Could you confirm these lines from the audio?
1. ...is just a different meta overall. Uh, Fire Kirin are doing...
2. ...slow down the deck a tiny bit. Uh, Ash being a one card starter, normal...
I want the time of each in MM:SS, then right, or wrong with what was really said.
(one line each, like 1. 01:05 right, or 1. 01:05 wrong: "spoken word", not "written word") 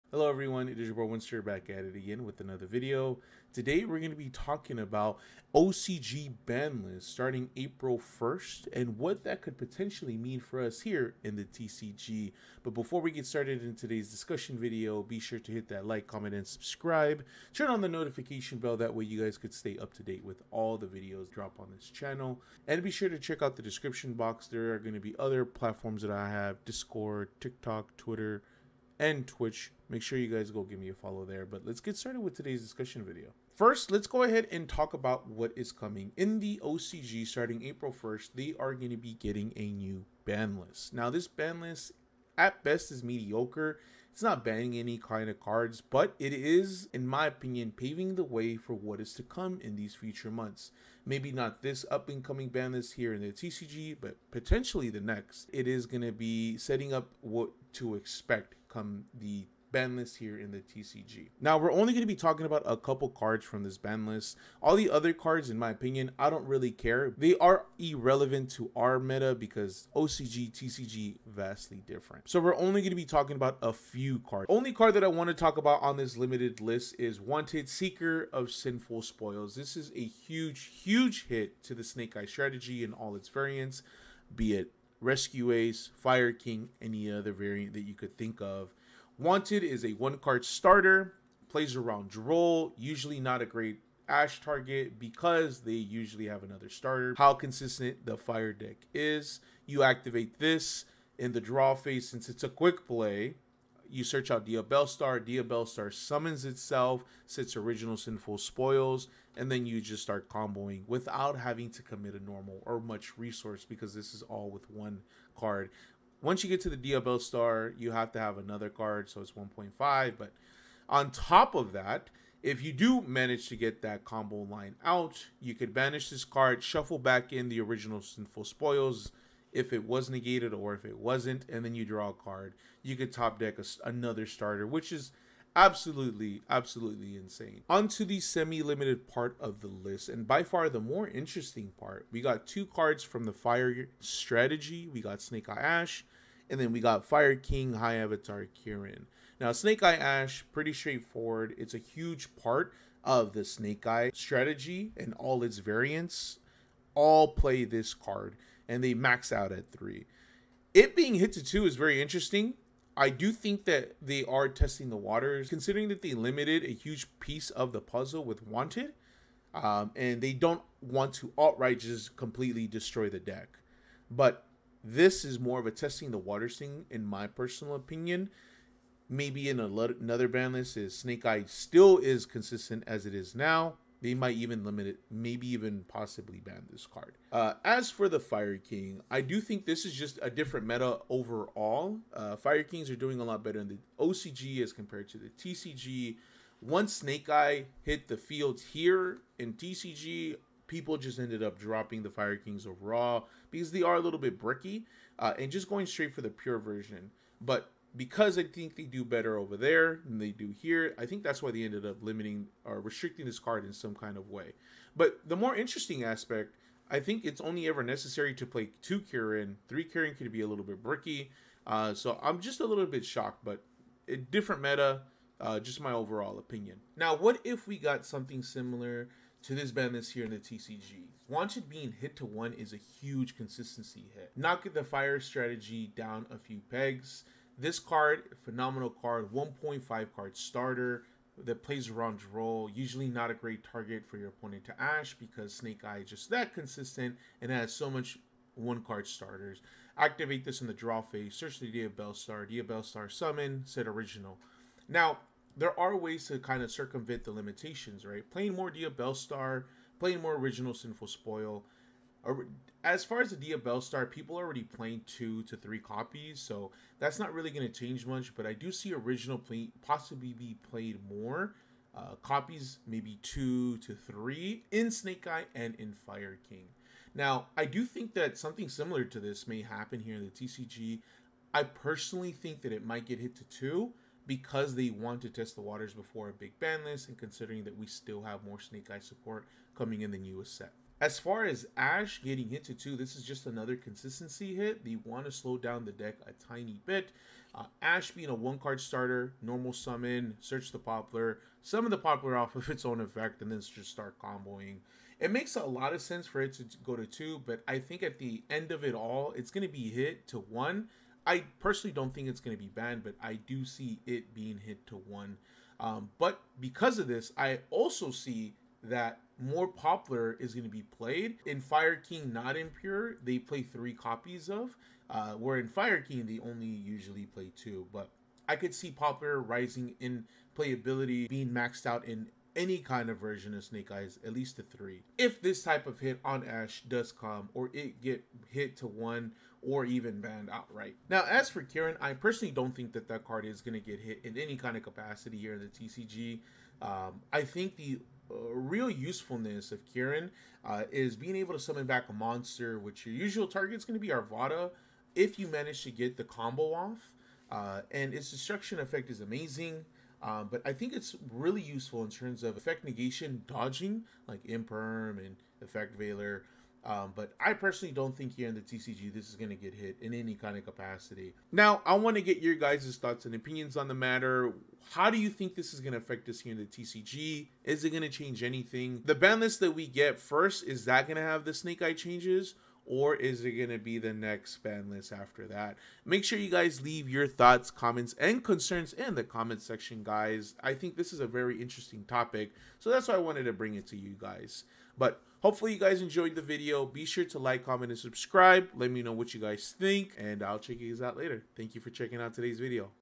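1. 03:09 wrong: "Kings", not "Kirin"
2. 04:55 right.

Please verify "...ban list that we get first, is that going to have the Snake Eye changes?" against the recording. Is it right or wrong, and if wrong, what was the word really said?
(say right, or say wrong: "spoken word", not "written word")
right.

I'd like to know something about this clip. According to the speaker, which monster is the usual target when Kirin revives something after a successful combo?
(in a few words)
Arvata.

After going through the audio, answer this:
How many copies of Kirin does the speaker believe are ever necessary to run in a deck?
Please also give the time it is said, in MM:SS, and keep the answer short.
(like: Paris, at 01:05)
2, at 03:38.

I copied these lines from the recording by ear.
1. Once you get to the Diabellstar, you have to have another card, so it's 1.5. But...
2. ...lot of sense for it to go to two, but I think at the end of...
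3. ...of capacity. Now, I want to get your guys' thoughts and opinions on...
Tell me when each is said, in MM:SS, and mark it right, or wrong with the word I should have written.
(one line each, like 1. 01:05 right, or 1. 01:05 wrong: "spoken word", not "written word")
1. 01:56 right
2. 05:05 right
3. 06:10 right.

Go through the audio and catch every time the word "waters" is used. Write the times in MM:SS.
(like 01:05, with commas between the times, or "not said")
02:44, 02:56, 04:45.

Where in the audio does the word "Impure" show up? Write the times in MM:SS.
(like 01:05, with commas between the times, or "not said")
05:22.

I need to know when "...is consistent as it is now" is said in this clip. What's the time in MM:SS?
03:01.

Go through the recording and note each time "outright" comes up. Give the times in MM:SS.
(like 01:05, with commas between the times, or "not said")
02:51, 05:40.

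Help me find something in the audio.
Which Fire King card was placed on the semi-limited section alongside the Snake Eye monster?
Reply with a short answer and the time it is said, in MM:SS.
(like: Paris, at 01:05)
Fire King High Avatar Kirin, at 02:27.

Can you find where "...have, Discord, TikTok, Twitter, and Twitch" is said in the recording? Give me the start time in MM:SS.
00:26.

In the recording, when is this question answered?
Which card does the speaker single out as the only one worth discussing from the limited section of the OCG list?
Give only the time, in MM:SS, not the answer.
01:17.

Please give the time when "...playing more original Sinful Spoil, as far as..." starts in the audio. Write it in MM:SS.
04:19.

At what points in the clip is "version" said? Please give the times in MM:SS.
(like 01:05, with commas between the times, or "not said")
03:26, 05:33.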